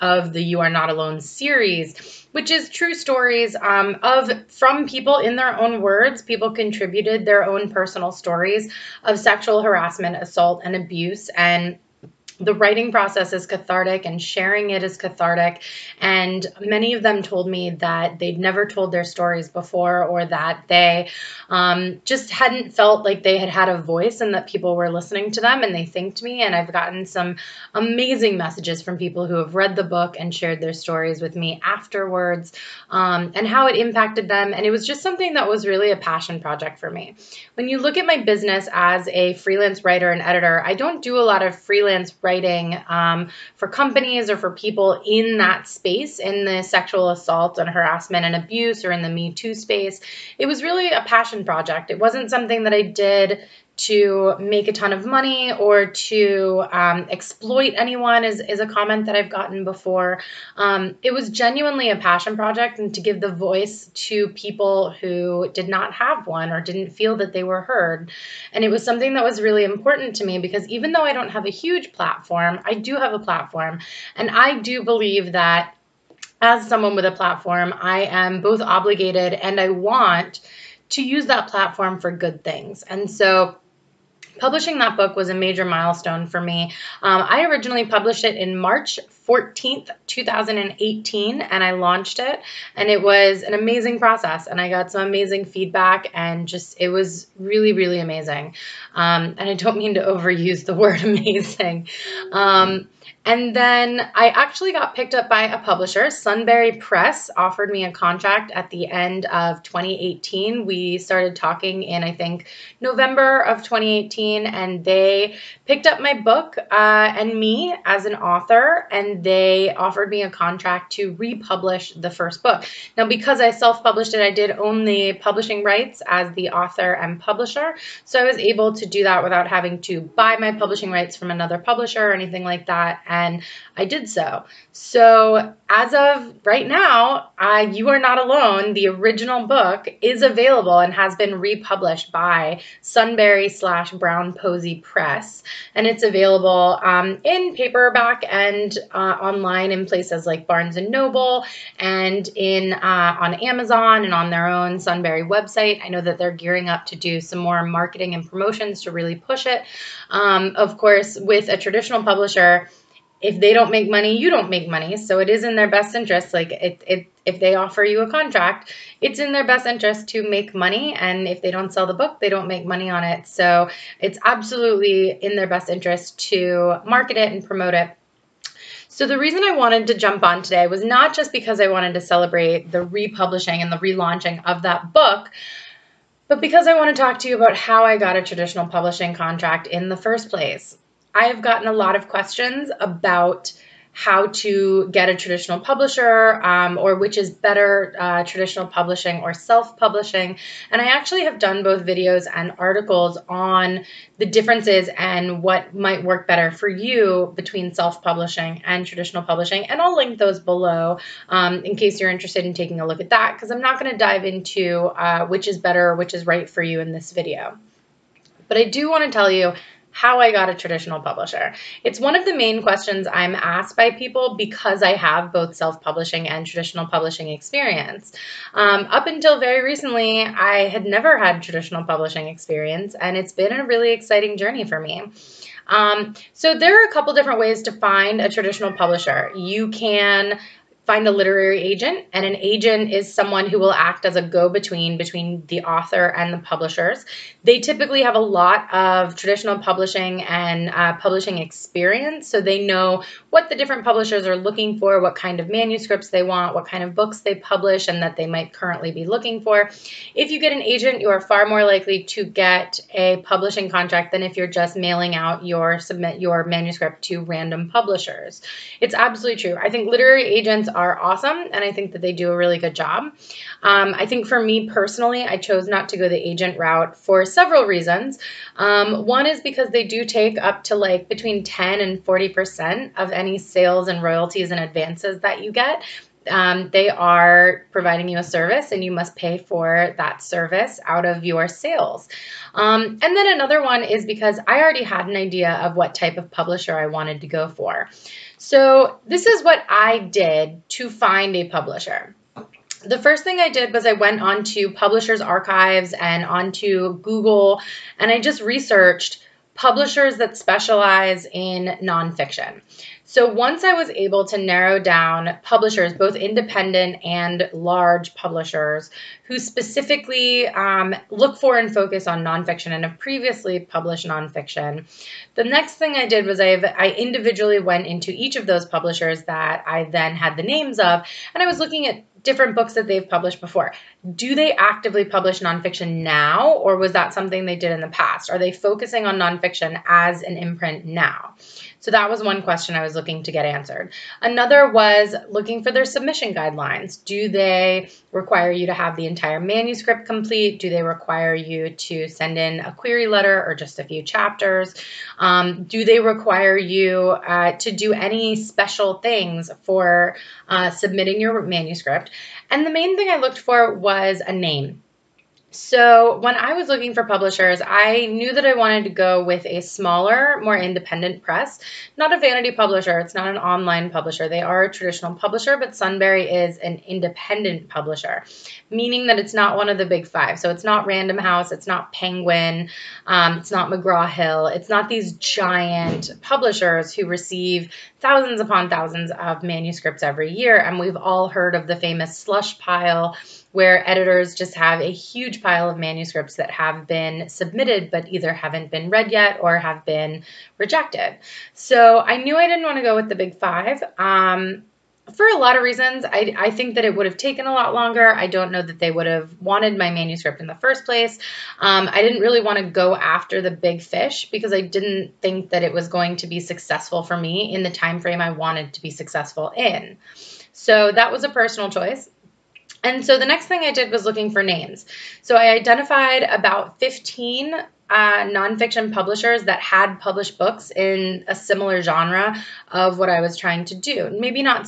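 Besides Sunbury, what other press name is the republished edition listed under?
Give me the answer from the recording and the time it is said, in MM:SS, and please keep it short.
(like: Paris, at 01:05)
Brown Posey Press, at 02:23.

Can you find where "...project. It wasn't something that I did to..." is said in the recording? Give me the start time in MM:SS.
00:51.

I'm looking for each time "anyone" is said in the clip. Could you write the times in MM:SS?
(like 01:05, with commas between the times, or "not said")
00:57.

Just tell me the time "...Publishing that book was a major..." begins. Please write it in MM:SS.
01:24.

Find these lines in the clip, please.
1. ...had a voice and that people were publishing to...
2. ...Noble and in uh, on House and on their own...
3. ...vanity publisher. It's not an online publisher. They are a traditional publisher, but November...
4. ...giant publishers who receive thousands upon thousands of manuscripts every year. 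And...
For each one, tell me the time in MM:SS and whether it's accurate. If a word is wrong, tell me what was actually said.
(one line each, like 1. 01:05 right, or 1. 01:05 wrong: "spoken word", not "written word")
1. 00:23 wrong: "listening", not "publishing"
2. 02:30 wrong: "Amazon", not "House"
3. 06:12 wrong: "Sunbury", not "November"
4. 06:25 right.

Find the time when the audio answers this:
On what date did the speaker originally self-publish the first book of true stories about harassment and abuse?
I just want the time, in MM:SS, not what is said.
01:28.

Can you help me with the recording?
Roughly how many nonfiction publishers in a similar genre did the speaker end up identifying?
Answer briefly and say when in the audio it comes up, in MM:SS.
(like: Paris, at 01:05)
15, at 07:06.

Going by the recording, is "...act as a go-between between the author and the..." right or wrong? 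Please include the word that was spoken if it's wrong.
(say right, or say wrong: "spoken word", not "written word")
right.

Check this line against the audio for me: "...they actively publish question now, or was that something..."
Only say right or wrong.
wrong.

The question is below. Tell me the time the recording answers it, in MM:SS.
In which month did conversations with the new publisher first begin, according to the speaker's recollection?
01:52.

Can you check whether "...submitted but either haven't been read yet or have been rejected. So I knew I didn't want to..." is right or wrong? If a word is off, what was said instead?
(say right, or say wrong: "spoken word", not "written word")
right.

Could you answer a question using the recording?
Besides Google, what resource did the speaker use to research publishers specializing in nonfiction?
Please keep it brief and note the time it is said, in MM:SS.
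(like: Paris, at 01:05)
Publishers Archives, at 05:04.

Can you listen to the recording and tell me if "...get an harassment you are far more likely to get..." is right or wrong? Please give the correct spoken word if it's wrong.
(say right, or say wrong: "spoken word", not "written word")
wrong: "agent", not "harassment".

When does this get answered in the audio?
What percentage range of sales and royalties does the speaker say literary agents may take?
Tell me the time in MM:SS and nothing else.
04:41.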